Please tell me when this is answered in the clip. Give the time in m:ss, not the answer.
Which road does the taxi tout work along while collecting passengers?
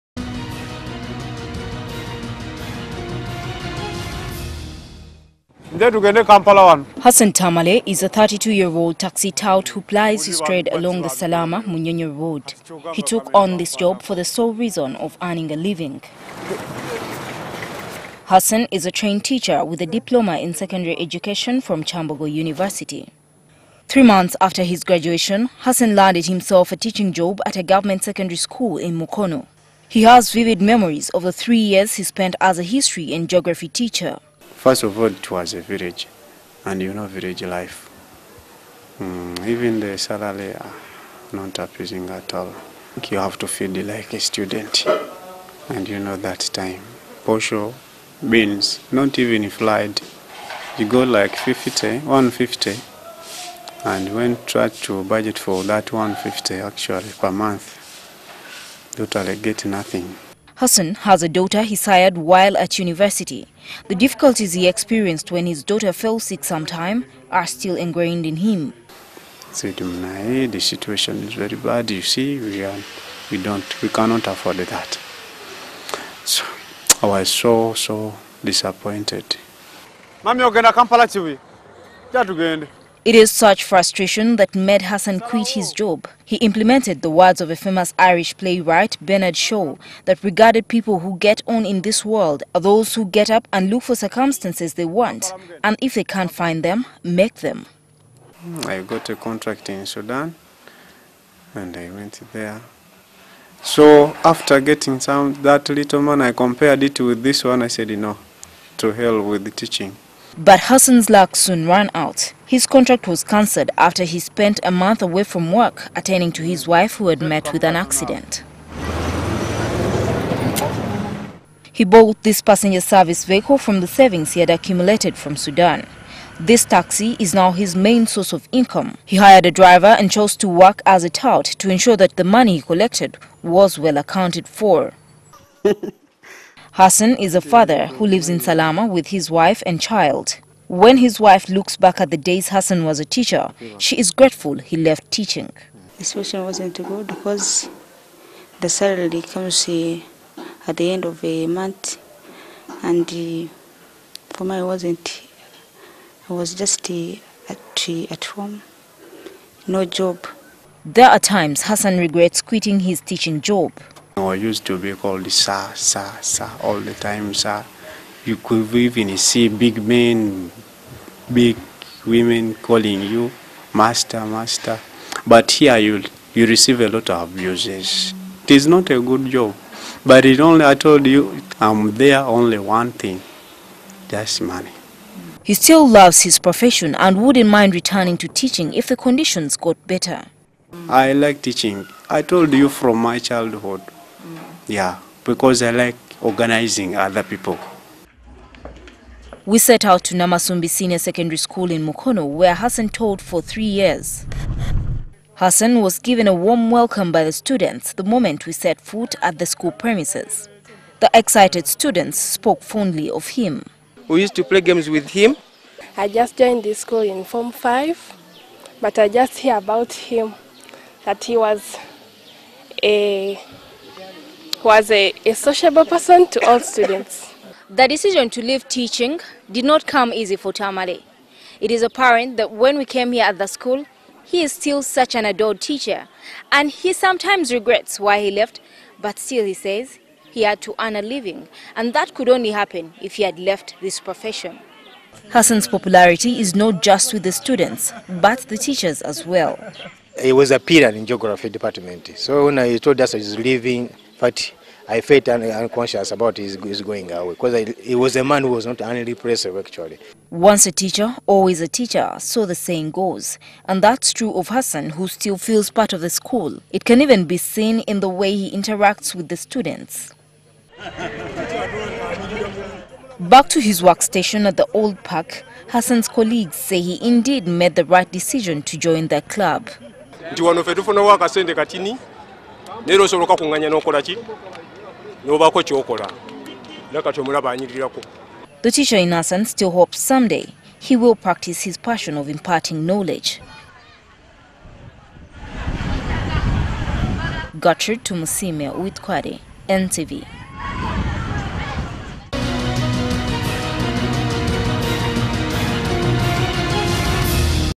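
0:11.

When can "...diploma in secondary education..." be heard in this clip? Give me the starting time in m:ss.
0:19.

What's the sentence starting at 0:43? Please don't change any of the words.
You have to feed like a student, and you know that time.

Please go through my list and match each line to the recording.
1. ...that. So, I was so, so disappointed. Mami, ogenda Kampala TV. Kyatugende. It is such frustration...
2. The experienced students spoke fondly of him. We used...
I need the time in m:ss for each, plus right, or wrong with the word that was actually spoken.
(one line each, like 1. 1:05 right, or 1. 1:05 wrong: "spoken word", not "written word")
1. 1:14 right
2. 3:31 wrong: "excited", not "experienced".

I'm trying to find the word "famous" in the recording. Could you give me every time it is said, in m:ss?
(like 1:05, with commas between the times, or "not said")
1:27.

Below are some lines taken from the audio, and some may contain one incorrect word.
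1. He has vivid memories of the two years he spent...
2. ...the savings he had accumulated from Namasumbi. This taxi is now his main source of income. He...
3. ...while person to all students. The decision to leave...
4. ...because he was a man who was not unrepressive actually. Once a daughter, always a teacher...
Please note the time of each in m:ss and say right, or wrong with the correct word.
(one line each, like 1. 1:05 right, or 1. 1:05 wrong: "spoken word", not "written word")
1. 0:29 wrong: "three", not "two"
2. 2:03 wrong: "Sudan", not "Namasumbi"
3. 3:45 wrong: "sociable", not "while"
4. 4:17 wrong: "teacher", not "daughter".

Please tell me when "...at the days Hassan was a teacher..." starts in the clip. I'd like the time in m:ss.
2:21.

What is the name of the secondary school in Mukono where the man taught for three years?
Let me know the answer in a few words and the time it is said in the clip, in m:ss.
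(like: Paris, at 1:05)
Namasumbi Senior Secondary School, at 3:20.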